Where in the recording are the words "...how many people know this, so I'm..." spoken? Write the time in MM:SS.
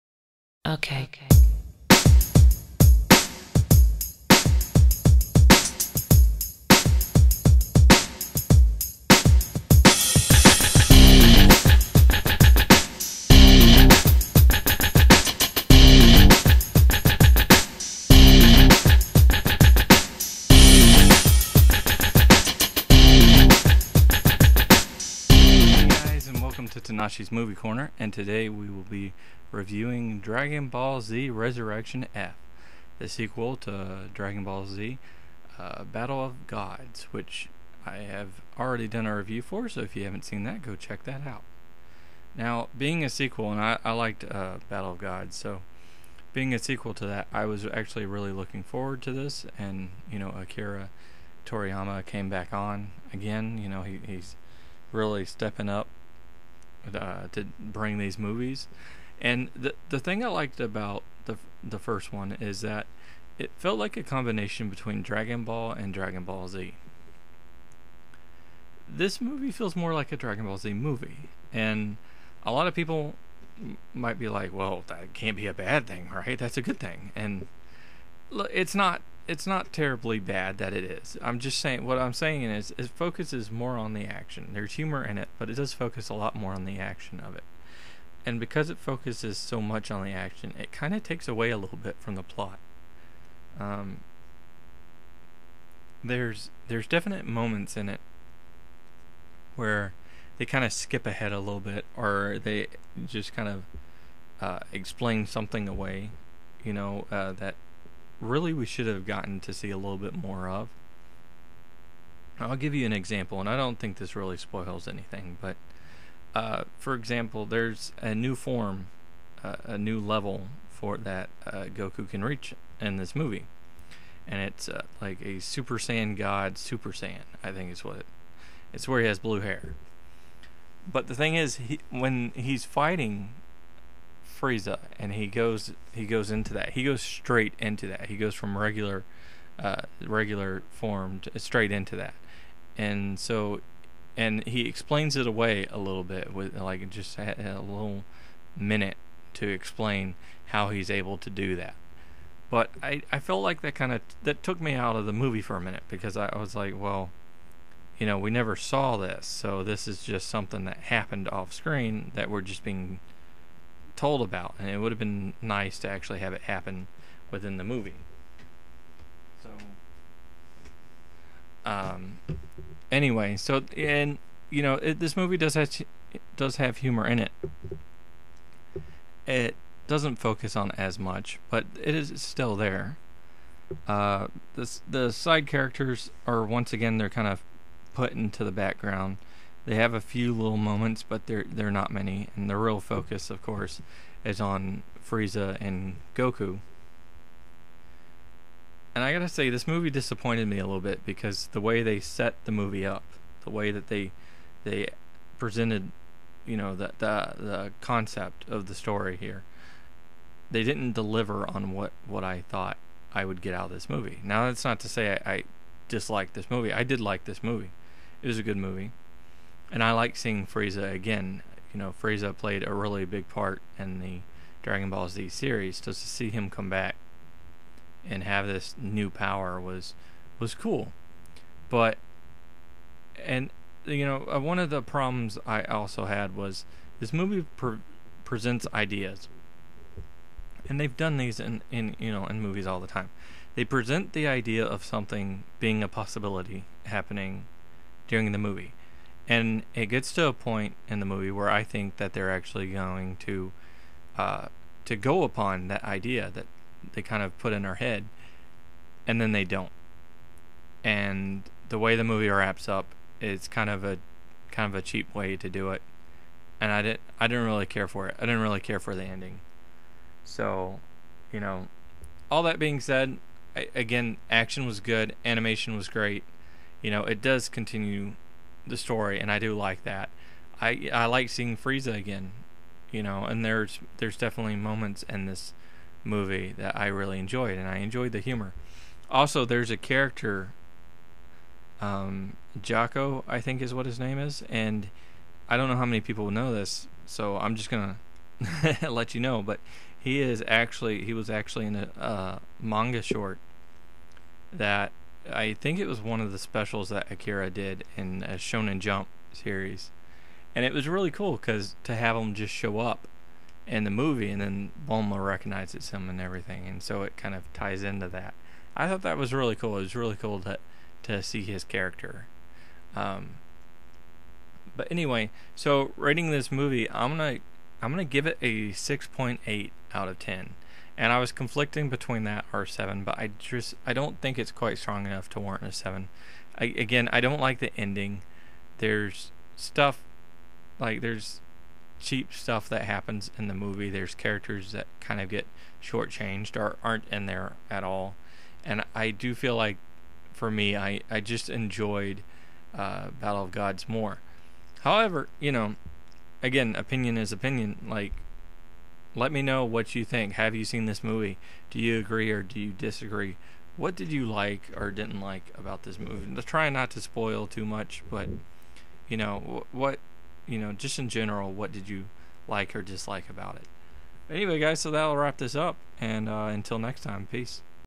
04:55.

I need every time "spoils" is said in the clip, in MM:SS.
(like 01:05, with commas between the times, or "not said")
01:54, 06:07.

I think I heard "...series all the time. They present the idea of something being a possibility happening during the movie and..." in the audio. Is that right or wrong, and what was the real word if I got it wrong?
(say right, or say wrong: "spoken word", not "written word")
wrong: "movies", not "series".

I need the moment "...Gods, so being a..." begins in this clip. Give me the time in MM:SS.
00:44.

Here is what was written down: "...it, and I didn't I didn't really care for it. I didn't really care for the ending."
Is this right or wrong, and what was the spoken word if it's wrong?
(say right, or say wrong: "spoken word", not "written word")
right.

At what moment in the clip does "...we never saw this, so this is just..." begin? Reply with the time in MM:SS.
02:38.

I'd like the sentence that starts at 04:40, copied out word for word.
I I like seeing Frieza again, you know.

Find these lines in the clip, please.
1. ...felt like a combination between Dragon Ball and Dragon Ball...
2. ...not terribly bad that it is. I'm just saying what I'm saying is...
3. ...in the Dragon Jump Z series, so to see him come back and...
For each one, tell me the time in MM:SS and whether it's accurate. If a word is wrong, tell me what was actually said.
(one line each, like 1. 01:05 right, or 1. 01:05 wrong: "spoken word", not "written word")
1. 01:03 right
2. 01:19 right
3. 03:43 wrong: "Ball", not "Jump".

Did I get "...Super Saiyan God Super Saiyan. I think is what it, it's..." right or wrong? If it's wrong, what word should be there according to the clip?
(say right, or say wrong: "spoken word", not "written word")
right.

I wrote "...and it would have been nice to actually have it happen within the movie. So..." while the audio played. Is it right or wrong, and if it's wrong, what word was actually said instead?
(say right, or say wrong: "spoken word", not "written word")
right.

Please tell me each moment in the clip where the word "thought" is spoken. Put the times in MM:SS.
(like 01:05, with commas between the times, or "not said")
03:32, 05:18.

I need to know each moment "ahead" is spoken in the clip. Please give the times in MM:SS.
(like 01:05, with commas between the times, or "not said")
01:41.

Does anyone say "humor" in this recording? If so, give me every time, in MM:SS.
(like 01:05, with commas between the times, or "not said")
01:24, 02:56, 04:48.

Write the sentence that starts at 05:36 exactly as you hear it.
I, again, I don't like the ending.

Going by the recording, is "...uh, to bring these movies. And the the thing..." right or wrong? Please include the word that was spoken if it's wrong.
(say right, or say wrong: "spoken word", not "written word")
right.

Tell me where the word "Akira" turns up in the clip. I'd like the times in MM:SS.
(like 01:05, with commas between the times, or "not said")
00:50, 05:07.